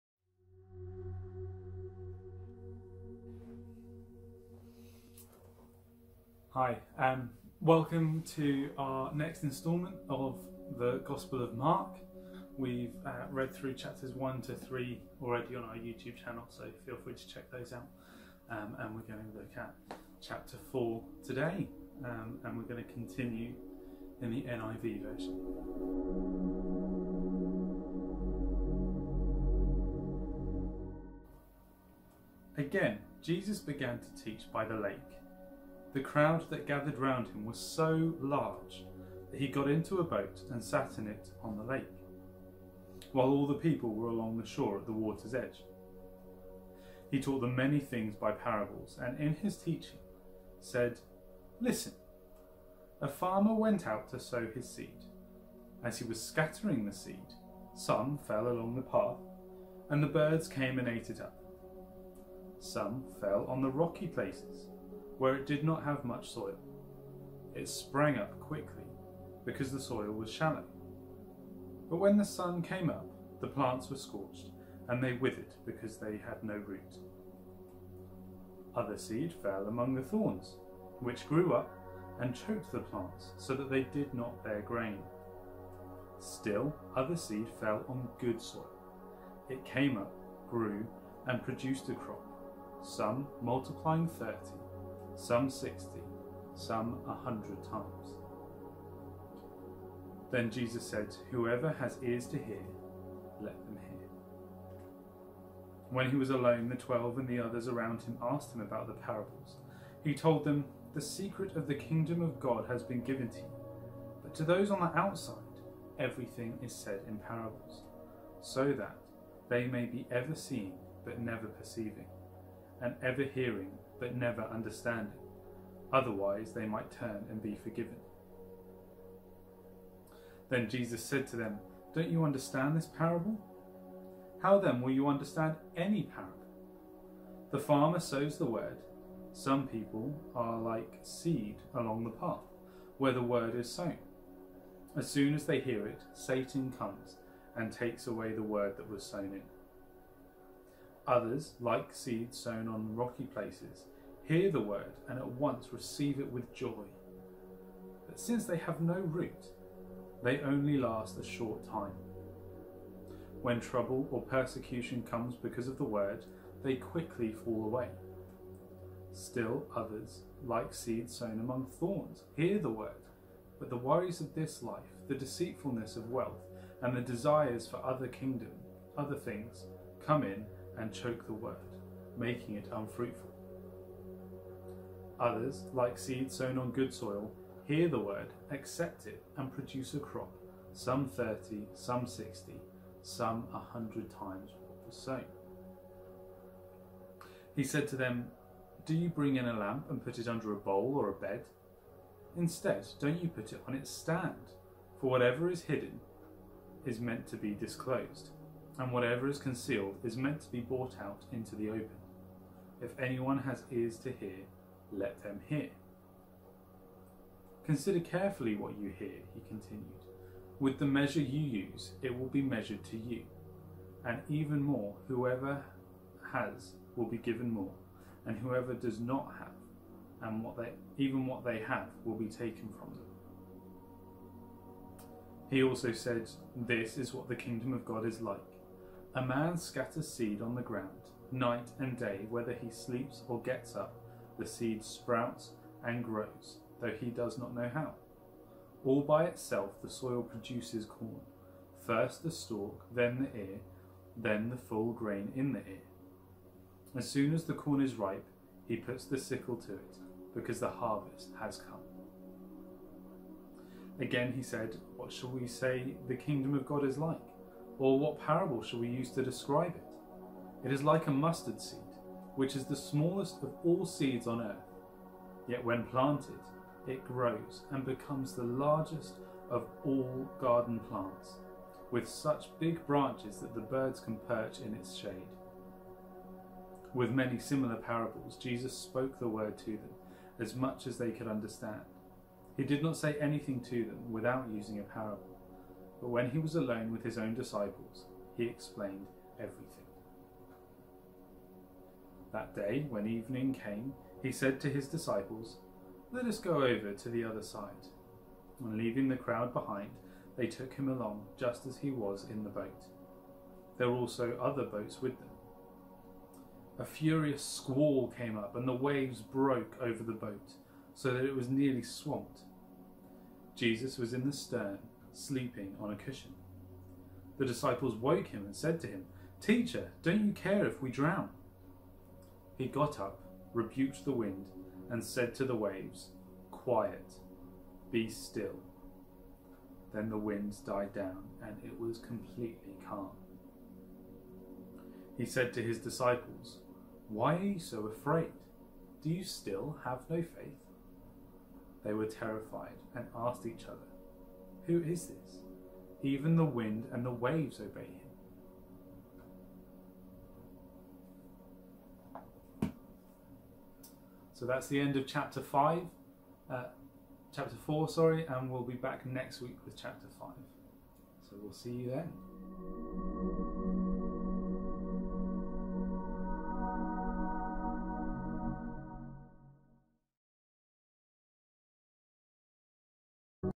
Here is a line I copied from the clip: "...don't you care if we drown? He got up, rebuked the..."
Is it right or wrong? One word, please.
right.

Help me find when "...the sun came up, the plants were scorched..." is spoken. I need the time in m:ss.
1:12.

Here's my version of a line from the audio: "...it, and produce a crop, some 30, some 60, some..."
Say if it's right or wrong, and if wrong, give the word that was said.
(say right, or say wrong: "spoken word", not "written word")
right.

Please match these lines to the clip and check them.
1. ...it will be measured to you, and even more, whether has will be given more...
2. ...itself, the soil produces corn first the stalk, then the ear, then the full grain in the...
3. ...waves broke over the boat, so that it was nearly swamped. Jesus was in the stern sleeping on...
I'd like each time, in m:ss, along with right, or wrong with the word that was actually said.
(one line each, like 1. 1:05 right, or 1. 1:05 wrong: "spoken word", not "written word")
1. 3:42 wrong: "whoever", not "whether"
2. 4:09 right
3. 5:18 right.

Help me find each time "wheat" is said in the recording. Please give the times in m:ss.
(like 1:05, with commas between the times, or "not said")
not said.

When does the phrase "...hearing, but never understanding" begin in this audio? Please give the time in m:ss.
2:03.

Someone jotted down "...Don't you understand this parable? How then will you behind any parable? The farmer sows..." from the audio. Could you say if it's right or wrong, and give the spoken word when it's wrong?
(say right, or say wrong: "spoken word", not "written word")
wrong: "understand", not "behind".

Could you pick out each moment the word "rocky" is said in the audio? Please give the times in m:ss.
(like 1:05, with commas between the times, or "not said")
1:03, 2:32.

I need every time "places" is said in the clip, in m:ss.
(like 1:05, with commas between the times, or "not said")
1:04, 2:33.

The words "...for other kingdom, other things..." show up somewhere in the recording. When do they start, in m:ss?
2:57.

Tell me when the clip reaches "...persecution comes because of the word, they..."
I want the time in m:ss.
2:44.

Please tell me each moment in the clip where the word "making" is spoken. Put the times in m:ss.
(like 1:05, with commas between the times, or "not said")
3:02.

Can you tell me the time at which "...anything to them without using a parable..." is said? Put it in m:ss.
4:53.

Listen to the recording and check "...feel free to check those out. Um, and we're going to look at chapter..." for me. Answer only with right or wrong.
right.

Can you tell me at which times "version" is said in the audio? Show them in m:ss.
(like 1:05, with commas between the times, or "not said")
0:25.